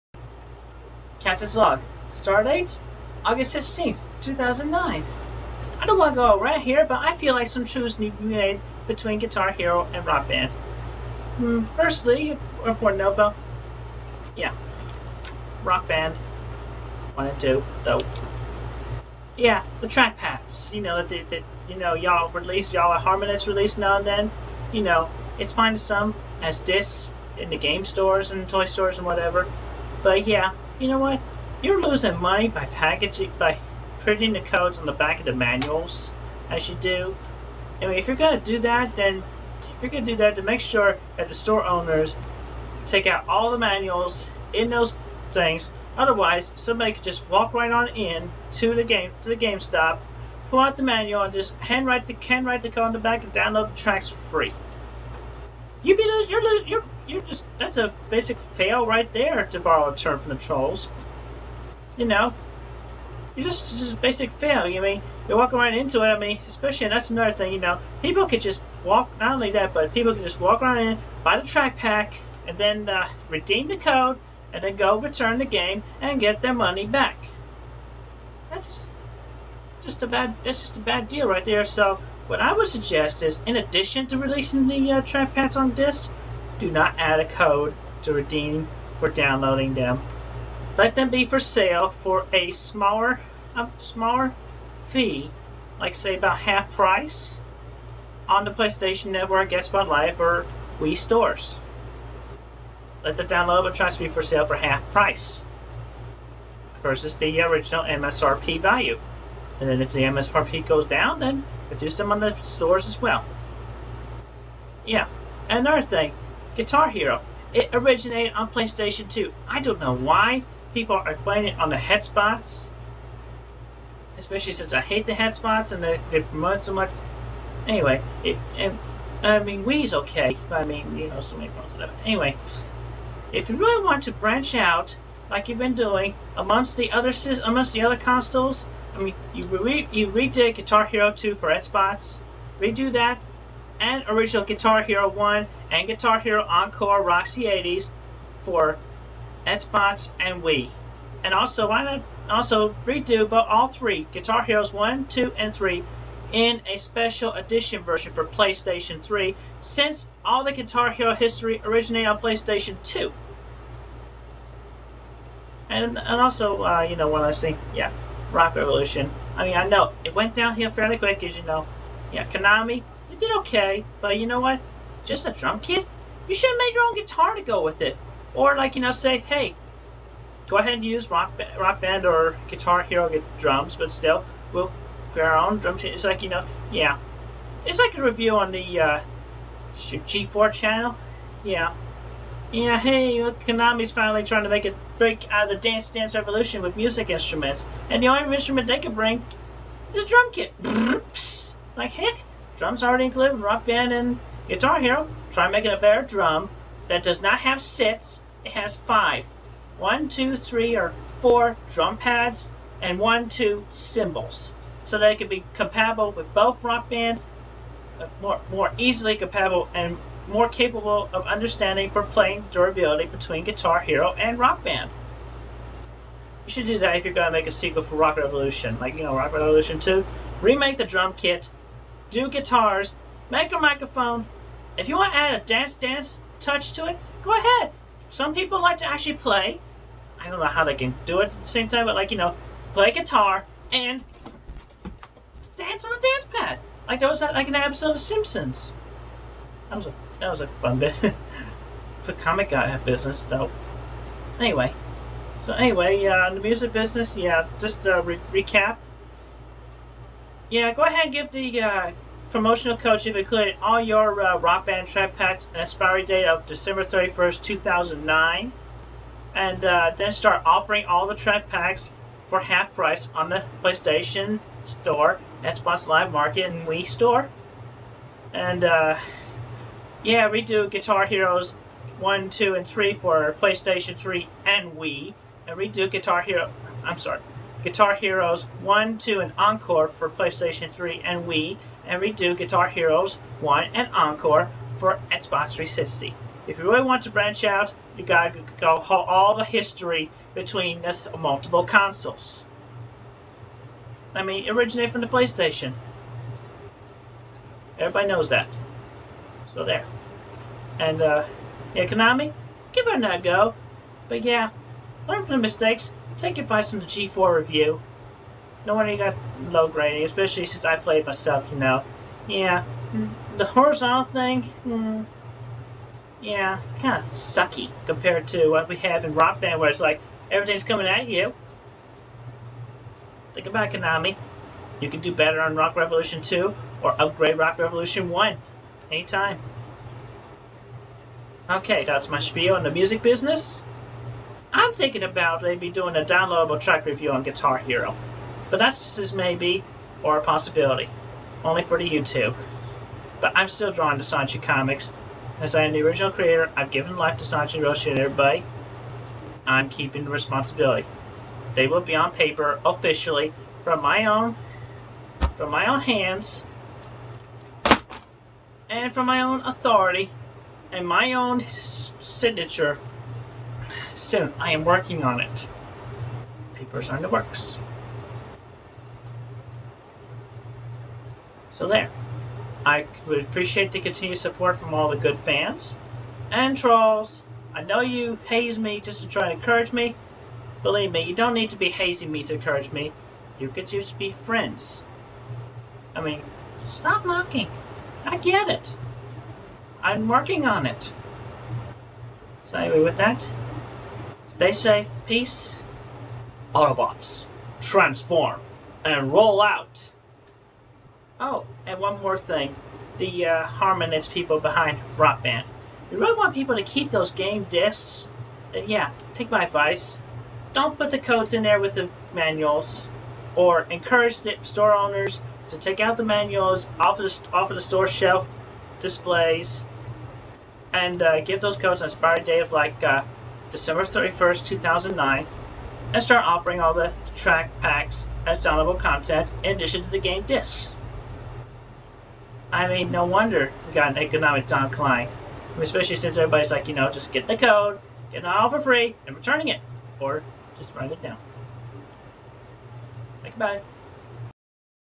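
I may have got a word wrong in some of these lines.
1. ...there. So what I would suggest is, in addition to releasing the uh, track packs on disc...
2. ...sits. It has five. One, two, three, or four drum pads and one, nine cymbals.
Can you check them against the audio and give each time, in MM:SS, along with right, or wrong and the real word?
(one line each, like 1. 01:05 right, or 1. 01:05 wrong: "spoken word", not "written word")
1. 01:21 right
2. 03:27 wrong: "two", not "nine".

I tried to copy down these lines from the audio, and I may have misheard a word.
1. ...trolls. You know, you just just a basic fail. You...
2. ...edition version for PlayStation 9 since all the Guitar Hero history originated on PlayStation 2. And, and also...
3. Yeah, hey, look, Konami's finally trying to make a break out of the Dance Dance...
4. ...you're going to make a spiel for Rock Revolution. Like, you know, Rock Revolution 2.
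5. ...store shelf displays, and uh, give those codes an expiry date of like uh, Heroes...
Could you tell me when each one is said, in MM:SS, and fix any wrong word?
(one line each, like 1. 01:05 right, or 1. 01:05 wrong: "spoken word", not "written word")
1. 01:00 right
2. 02:37 wrong: "3", not "9"
3. 03:12 right
4. 03:47 wrong: "sequel", not "spiel"
5. 07:07 wrong: "December", not "Heroes".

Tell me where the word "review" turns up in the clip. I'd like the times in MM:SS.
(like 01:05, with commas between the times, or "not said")
03:08, 05:17, 05:46.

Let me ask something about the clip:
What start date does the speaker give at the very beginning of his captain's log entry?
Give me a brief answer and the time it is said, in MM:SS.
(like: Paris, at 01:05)
August 16th, 2009, at 00:03.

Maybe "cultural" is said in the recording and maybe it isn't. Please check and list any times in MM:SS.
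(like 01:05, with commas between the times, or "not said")
not said.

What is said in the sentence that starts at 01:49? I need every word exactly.
And then if the MSRP goes down, then reduce them on the stores as well.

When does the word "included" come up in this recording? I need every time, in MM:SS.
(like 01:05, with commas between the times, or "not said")
03:23, 04:23.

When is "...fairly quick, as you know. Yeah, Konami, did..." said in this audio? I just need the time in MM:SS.
02:50.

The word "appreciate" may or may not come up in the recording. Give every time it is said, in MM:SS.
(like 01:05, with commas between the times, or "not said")
06:23.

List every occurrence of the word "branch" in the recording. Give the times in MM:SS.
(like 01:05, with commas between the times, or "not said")
02:14, 04:57.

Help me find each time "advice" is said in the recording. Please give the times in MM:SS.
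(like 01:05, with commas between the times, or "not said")
05:16, 06:59.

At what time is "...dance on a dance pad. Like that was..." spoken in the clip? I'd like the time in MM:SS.
04:05.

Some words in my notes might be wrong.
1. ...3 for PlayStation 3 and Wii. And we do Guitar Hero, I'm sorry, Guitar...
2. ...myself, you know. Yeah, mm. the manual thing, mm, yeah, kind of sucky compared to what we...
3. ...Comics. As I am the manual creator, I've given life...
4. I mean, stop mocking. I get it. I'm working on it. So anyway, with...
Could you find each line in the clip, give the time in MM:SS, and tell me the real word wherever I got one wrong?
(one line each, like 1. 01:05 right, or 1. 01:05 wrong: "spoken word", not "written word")
1. 04:42 right
2. 05:21 wrong: "horizontal", not "manual"
3. 05:54 wrong: "original", not "manual"
4. 06:35 right.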